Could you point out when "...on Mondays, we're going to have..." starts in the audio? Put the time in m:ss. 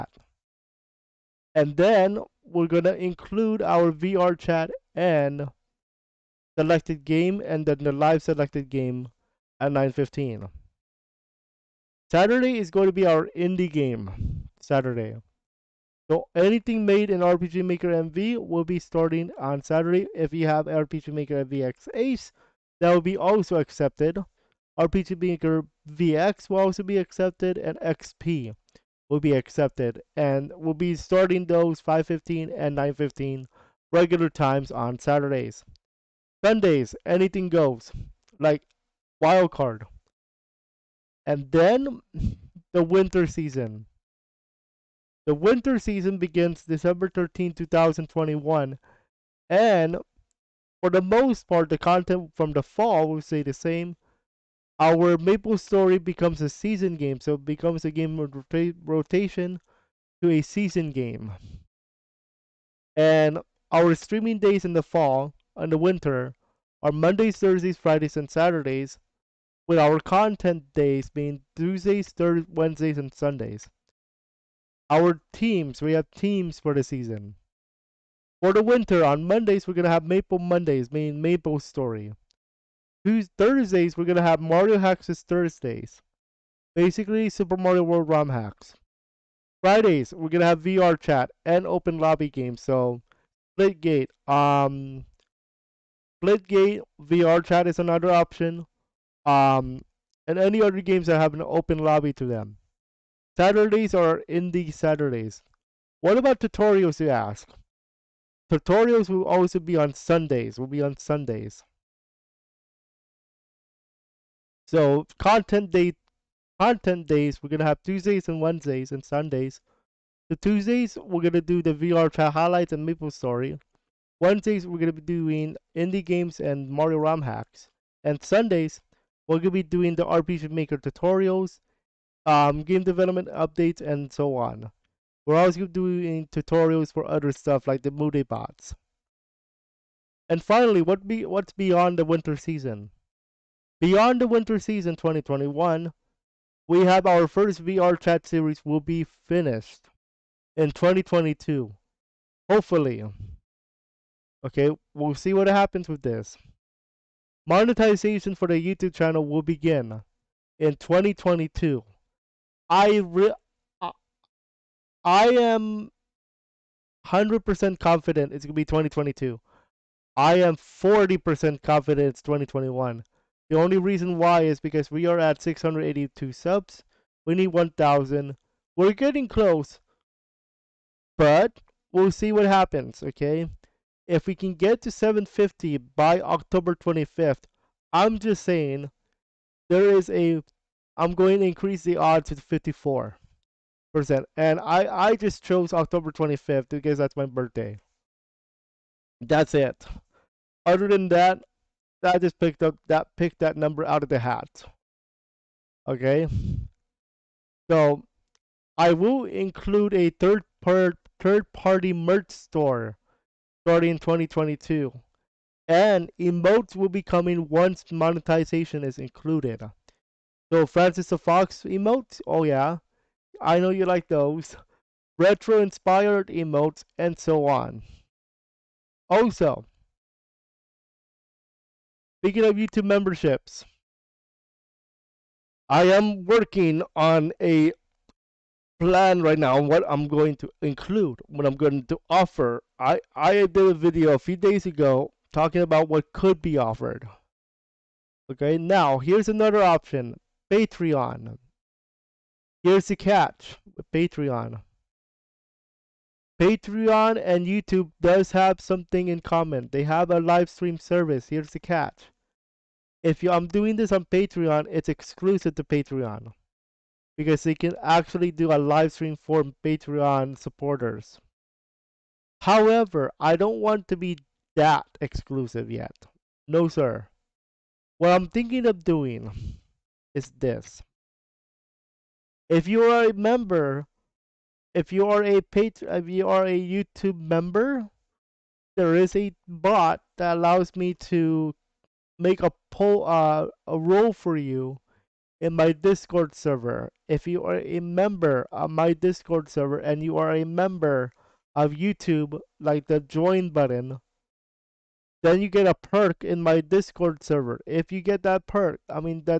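1:19.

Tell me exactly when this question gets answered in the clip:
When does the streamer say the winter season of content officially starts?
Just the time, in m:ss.
0:46.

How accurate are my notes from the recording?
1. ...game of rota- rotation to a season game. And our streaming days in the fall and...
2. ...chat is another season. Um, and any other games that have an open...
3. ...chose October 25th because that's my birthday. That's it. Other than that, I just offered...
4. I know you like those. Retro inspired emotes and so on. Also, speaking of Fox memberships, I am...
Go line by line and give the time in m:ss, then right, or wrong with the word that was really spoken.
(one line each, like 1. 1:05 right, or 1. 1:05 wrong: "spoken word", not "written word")
1. 0:57 right
2. 1:37 wrong: "option", not "season"
3. 3:15 wrong: "picked", not "offered"
4. 3:43 wrong: "YouTube", not "Fox".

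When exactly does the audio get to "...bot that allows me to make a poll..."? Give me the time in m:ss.
4:49.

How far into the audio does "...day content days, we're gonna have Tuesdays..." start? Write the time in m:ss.
1:55.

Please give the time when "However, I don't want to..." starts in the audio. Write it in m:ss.
4:32.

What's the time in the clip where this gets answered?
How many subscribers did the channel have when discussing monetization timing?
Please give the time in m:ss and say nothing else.
2:55.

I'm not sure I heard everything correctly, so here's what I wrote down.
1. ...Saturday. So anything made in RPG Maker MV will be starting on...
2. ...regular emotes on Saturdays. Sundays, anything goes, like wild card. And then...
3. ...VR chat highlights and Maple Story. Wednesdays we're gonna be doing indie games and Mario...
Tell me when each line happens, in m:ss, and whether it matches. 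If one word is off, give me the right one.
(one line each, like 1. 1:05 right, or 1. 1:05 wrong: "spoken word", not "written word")
1. 0:14 right
2. 0:33 wrong: "times", not "emotes"
3. 2:01 right.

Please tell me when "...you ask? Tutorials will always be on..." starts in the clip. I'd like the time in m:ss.
1:46.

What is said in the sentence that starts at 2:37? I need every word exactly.
Monetization for the YouTube channel will begin in 2022.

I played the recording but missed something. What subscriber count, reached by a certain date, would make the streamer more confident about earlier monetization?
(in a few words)
750.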